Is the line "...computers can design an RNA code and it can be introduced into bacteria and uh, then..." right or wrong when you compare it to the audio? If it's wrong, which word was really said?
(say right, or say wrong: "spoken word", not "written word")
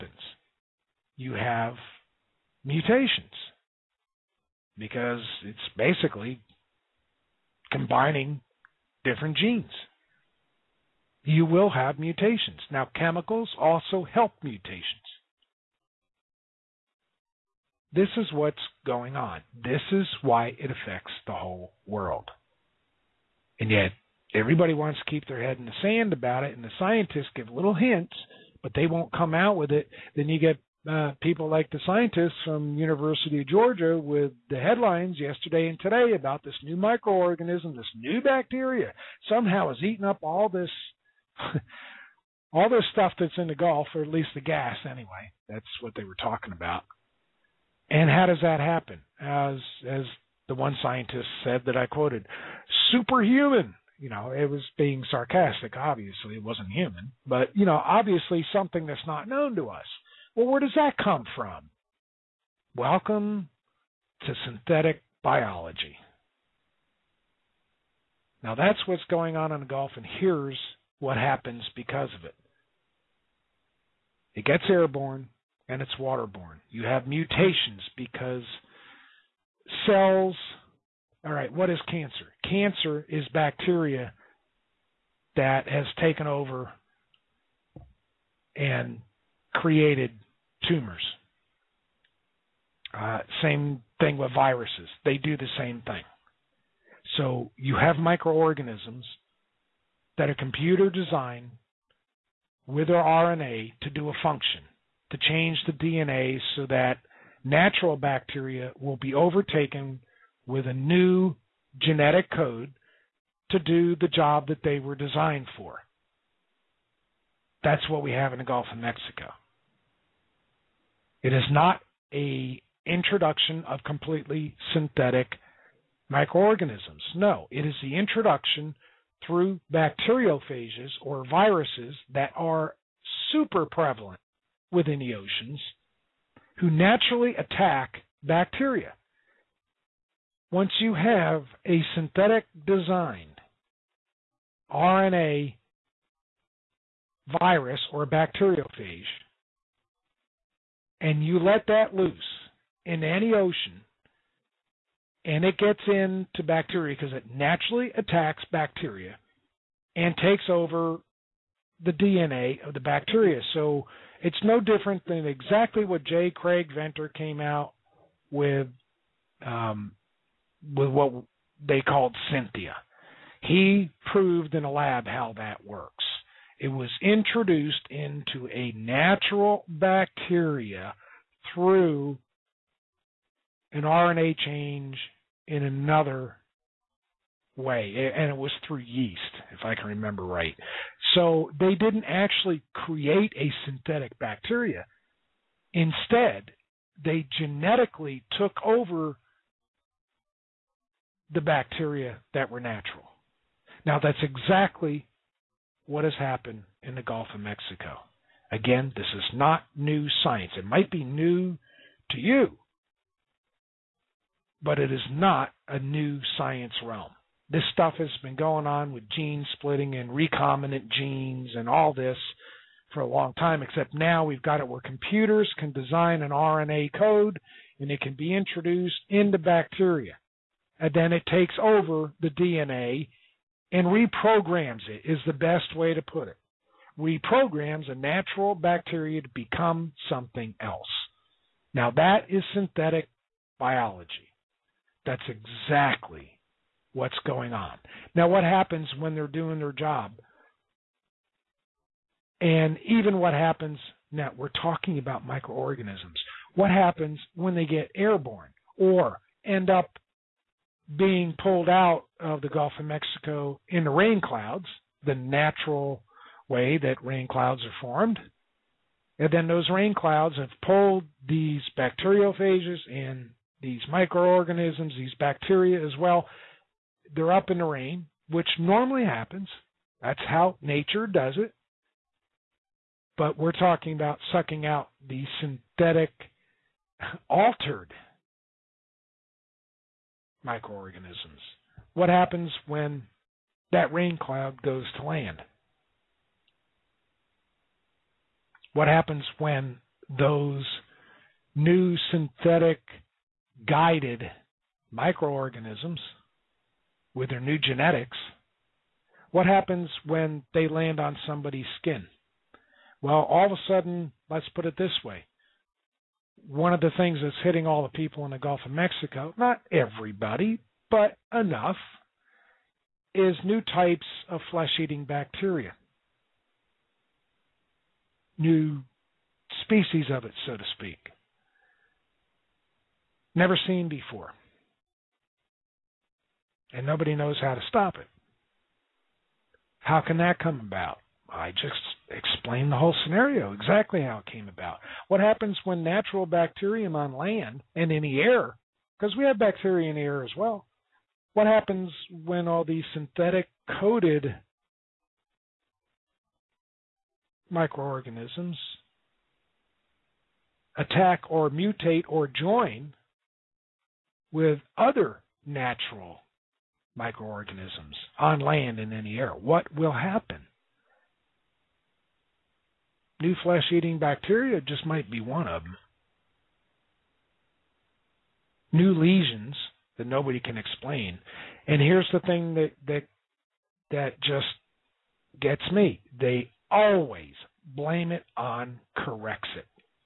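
right.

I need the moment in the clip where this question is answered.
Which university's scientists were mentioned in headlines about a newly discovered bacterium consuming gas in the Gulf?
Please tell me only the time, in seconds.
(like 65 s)
32 s.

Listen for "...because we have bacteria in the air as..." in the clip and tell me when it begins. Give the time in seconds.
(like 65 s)
348 s.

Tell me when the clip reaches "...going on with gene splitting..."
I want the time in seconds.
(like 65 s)
218 s.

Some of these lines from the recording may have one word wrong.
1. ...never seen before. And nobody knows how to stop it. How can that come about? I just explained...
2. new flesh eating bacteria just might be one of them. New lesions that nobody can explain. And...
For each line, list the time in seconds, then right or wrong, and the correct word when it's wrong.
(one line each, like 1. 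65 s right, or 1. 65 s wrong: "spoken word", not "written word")
1. 333 s right
2. 373 s right.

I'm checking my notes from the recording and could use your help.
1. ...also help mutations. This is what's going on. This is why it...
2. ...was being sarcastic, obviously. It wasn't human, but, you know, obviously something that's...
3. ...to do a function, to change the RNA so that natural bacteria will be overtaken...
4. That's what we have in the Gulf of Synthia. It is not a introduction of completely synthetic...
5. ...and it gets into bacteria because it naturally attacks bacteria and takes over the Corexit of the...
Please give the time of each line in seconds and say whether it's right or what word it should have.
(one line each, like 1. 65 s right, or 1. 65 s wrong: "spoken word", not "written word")
1. 13 s right
2. 54 s right
3. 103 s wrong: "DNA", not "RNA"
4. 117 s wrong: "Mexico", not "Synthia"
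5. 155 s wrong: "DNA", not "Corexit".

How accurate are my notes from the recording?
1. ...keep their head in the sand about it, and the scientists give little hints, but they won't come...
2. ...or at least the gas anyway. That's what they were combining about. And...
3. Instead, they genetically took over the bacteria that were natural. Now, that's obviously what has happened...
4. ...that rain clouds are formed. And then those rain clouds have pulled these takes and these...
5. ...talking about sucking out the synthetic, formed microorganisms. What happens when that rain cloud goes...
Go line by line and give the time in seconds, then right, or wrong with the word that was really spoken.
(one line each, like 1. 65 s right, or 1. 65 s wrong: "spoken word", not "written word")
1. 25 s right
2. 43 s wrong: "talking", not "combining"
3. 195 s wrong: "exactly", not "obviously"
4. 266 s wrong: "bacteriophages", not "takes"
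5. 283 s wrong: "altered", not "formed".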